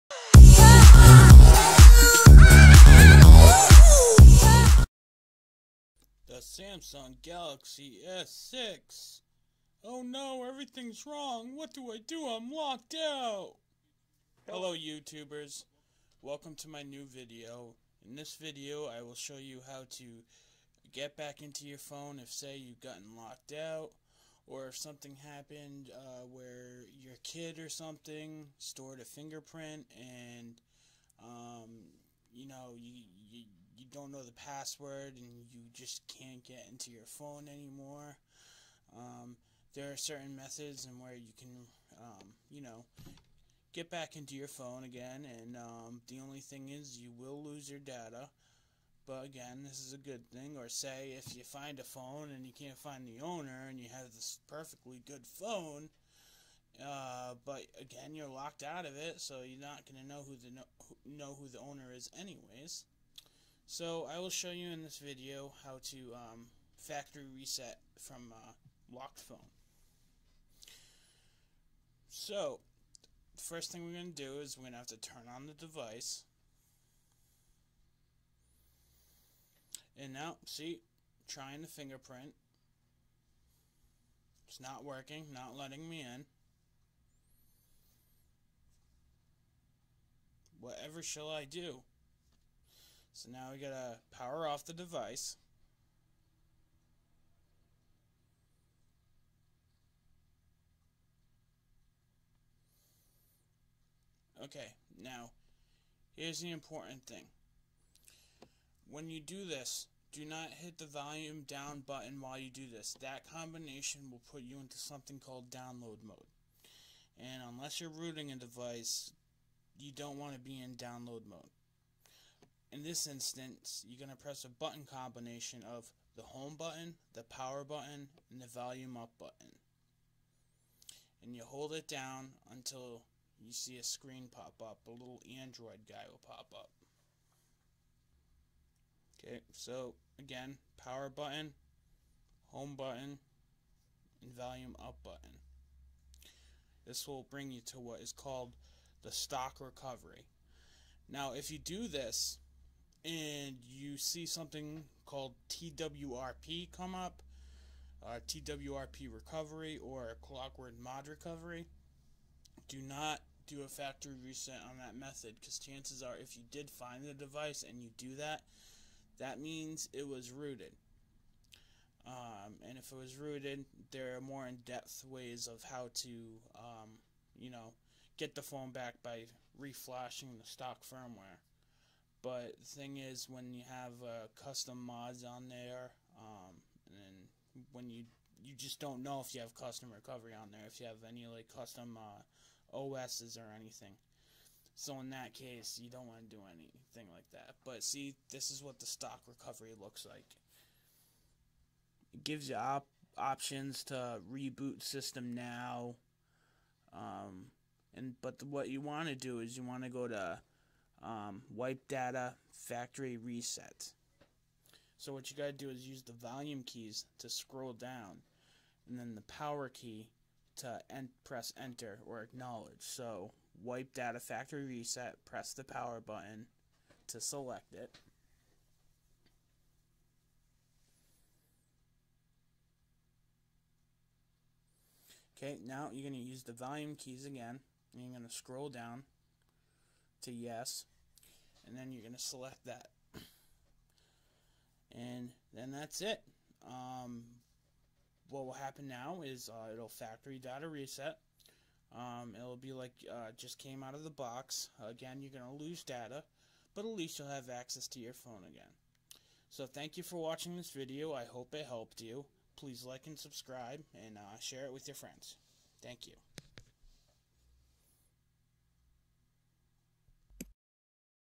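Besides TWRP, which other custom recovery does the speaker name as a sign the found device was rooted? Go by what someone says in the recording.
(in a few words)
clockwork mod recovery.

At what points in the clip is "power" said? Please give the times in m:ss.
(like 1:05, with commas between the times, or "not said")
1:34, 2:07, 2:20, 3:39, 3:45.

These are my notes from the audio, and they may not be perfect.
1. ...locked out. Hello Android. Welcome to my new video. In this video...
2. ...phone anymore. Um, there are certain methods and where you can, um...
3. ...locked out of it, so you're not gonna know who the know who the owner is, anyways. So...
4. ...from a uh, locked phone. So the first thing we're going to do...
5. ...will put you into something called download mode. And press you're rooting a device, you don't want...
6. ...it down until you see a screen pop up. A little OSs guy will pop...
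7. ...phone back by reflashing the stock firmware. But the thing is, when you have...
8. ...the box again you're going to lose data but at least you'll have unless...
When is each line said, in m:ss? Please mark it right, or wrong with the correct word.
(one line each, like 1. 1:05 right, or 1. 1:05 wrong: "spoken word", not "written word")
1. 0:12 wrong: "YouTubers", not "Android"
2. 0:37 right
3. 0:58 right
4. 1:07 right
5. 1:54 wrong: "unless", not "press"
6. 2:11 wrong: "Android", not "OSs"
7. 2:58 right
8. 4:14 wrong: "access", not "unless".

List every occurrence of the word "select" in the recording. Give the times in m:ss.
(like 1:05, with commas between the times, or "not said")
3:47, 4:02.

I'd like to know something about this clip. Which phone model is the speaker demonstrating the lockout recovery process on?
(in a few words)
Samsung Galaxy S6.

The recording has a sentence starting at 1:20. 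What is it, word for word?
And now, see, trying the fingerprint.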